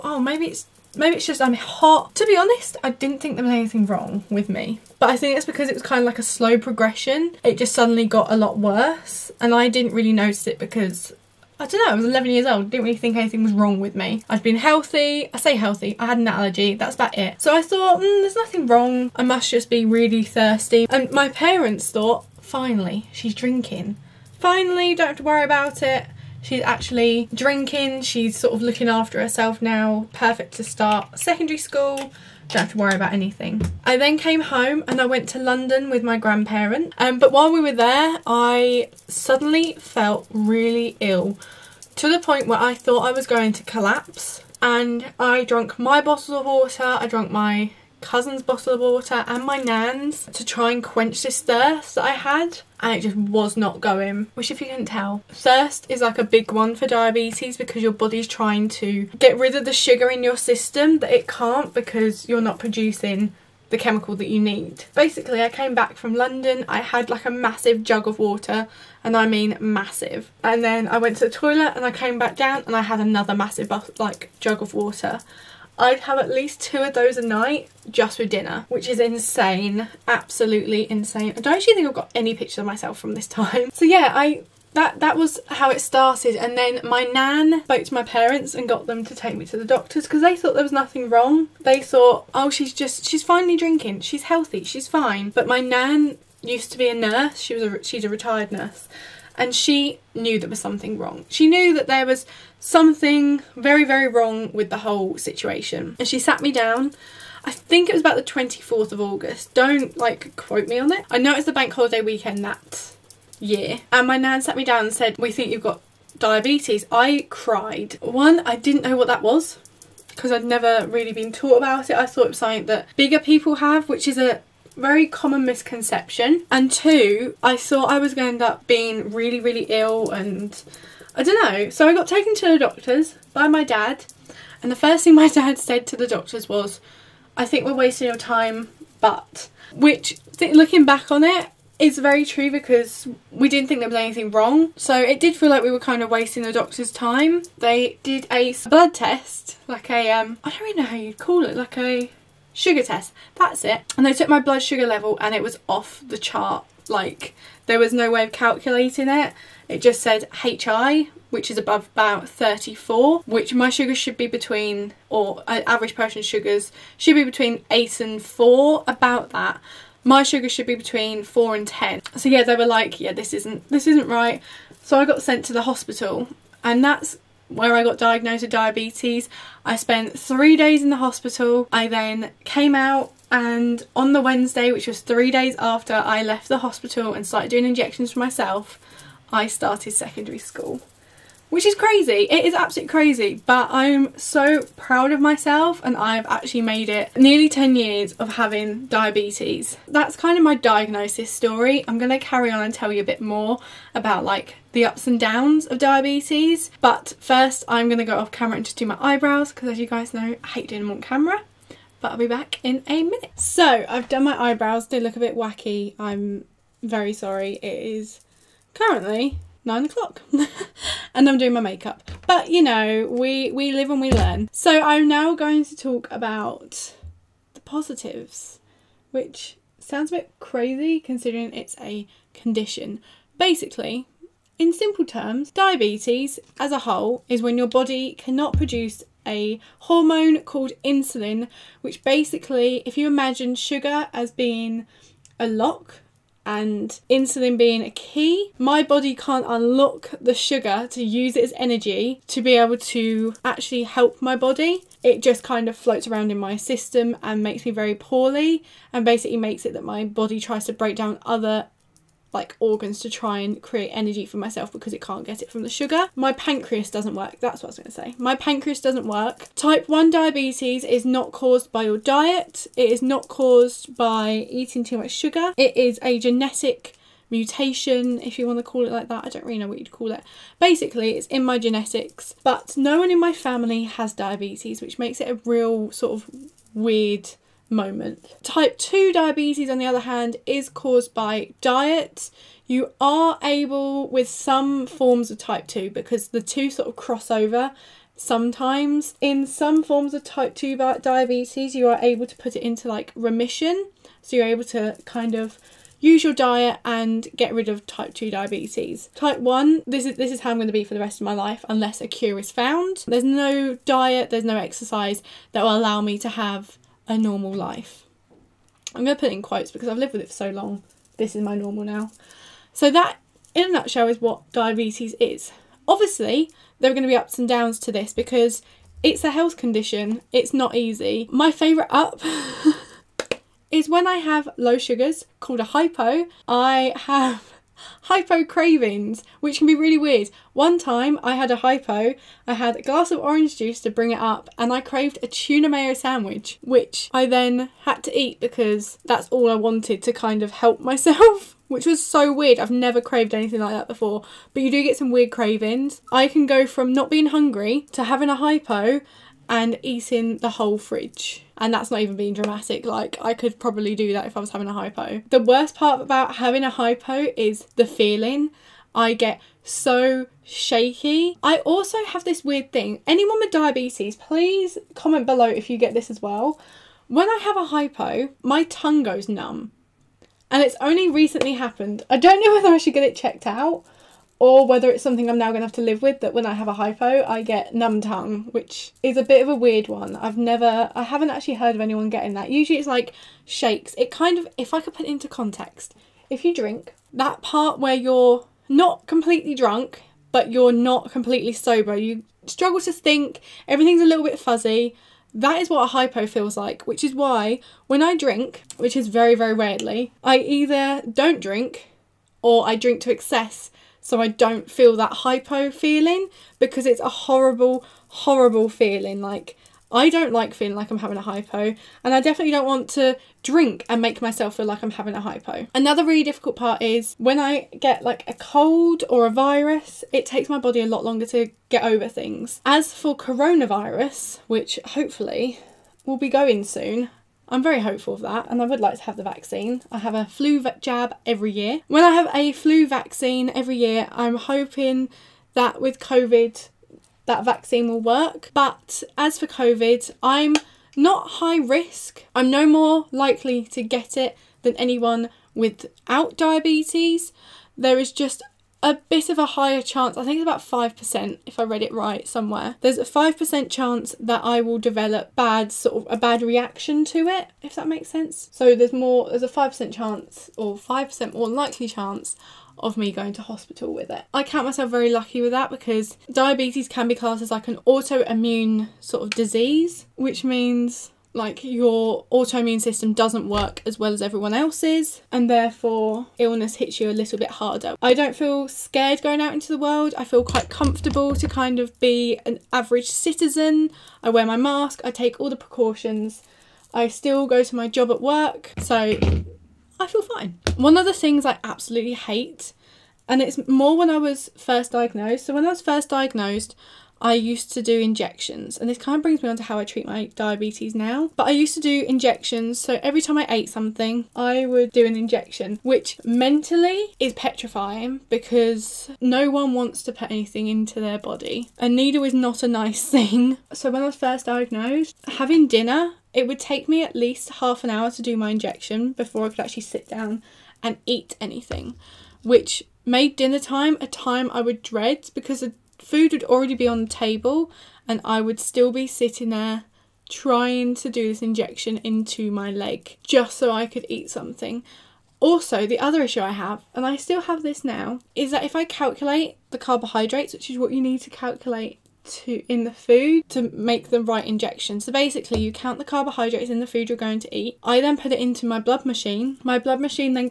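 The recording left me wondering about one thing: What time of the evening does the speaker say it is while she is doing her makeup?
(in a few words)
9 o'clock.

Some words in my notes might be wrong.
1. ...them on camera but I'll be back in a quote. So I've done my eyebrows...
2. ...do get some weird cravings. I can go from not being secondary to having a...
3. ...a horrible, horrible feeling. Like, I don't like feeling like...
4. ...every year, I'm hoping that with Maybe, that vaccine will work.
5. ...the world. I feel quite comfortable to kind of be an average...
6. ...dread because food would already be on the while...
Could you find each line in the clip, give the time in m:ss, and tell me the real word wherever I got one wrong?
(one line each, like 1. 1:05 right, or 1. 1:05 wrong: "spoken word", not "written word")
1. 3:30 wrong: "minute", not "quote"
2. 5:54 wrong: "hungry", not "secondary"
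3. 6:57 right
4. 7:23 wrong: "COVID", not "Maybe"
5. 8:09 right
6. 8:54 wrong: "table", not "while".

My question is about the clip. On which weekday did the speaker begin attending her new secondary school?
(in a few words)
Wednesday.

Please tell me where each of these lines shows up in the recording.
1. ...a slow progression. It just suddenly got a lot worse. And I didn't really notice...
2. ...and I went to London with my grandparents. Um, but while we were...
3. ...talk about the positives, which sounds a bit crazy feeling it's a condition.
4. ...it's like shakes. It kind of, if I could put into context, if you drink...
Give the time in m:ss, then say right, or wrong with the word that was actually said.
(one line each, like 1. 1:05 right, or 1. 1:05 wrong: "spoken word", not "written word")
1. 0:06 right
2. 0:34 right
3. 3:45 wrong: "considering", not "feeling"
4. 6:32 right.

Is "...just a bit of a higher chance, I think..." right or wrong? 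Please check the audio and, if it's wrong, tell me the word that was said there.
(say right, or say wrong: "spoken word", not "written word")
right.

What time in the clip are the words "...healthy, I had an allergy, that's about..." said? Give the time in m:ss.
0:15.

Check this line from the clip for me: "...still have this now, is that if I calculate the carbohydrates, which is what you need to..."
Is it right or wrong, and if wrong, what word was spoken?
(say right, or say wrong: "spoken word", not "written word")
right.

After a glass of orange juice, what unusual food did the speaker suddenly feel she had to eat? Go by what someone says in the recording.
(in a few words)
Tuna mayo sandwich.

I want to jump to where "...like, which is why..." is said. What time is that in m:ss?
6:46.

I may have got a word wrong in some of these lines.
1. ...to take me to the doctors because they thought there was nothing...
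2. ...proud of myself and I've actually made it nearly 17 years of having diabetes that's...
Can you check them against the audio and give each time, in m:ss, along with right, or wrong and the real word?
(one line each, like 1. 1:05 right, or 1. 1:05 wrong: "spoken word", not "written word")
1. 1:29 right
2. 3:14 wrong: "10", not "17".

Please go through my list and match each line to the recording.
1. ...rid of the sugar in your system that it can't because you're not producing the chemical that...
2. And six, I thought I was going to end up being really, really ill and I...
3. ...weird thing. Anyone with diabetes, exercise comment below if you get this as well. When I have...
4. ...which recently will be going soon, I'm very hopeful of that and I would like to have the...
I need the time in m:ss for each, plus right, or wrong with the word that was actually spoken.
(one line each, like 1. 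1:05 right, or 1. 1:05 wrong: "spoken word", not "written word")
1. 0:59 right
2. 2:06 wrong: "two", not "six"
3. 6:12 wrong: "please", not "exercise"
4. 7:14 wrong: "hopefully", not "recently".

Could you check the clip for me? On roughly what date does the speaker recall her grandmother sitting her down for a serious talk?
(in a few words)
24th of August.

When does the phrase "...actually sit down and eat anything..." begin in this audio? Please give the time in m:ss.
8:49.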